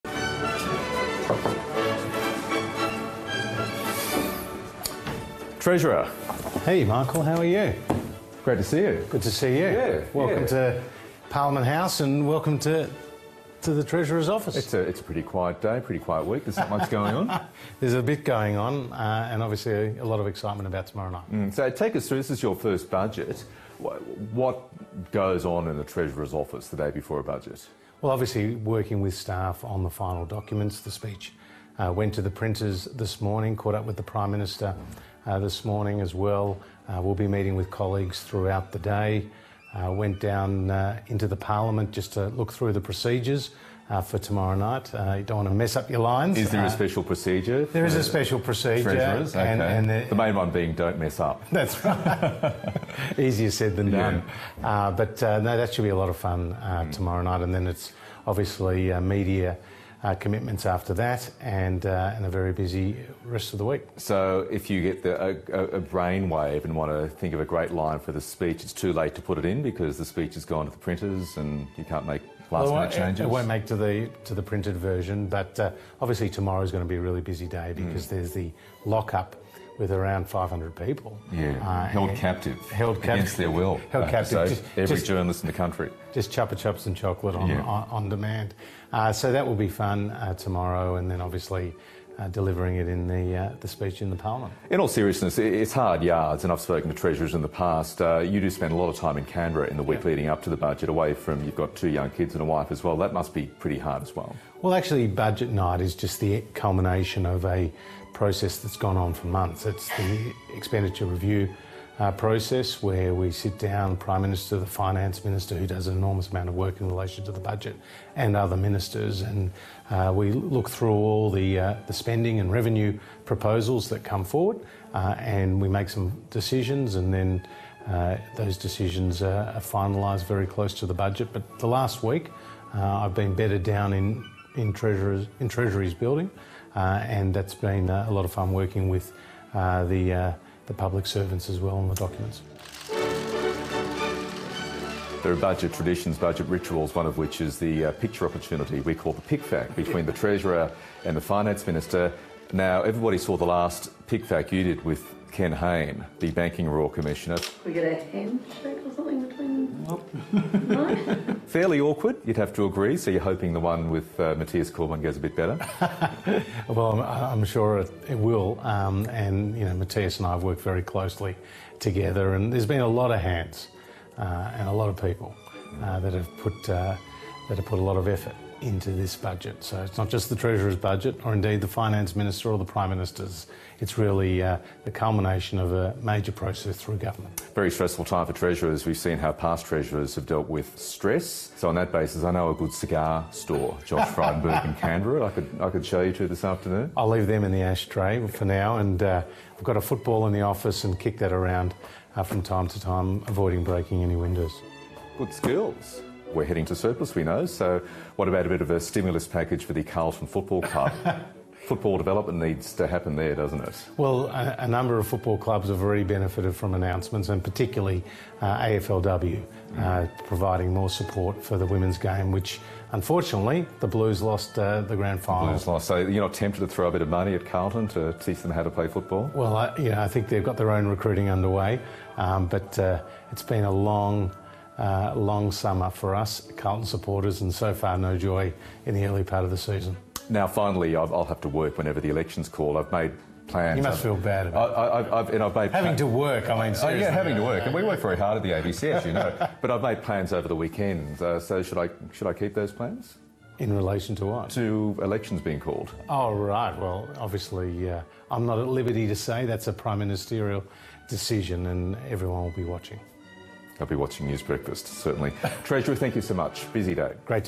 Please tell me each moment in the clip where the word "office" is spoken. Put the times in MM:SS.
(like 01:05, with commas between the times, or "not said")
00:14, 00:26, 03:20.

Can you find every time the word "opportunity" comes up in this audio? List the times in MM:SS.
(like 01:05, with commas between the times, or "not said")
02:28.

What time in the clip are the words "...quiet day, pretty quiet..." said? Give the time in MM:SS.
00:15.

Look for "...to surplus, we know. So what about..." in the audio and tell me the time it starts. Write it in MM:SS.
03:26.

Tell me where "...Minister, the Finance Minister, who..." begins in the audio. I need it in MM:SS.
01:54.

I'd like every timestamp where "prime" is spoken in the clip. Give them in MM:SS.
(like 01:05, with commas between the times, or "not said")
00:34, 01:53, 03:02, 04:19.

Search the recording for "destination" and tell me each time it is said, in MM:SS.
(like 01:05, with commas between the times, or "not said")
not said.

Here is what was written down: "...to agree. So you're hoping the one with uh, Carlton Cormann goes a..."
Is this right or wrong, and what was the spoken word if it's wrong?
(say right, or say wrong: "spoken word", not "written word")
wrong: "Mathias", not "Carlton".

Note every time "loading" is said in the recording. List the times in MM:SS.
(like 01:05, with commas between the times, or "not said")
not said.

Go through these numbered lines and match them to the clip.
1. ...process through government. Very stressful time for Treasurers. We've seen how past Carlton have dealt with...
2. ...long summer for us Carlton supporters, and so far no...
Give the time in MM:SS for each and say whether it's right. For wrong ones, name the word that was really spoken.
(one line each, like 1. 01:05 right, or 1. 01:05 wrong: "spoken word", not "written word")
1. 03:06 wrong: "Treasurers", not "Carlton"
2. 03:55 right.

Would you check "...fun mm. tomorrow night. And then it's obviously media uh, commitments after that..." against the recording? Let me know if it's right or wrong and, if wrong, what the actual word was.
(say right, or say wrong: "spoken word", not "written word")
right.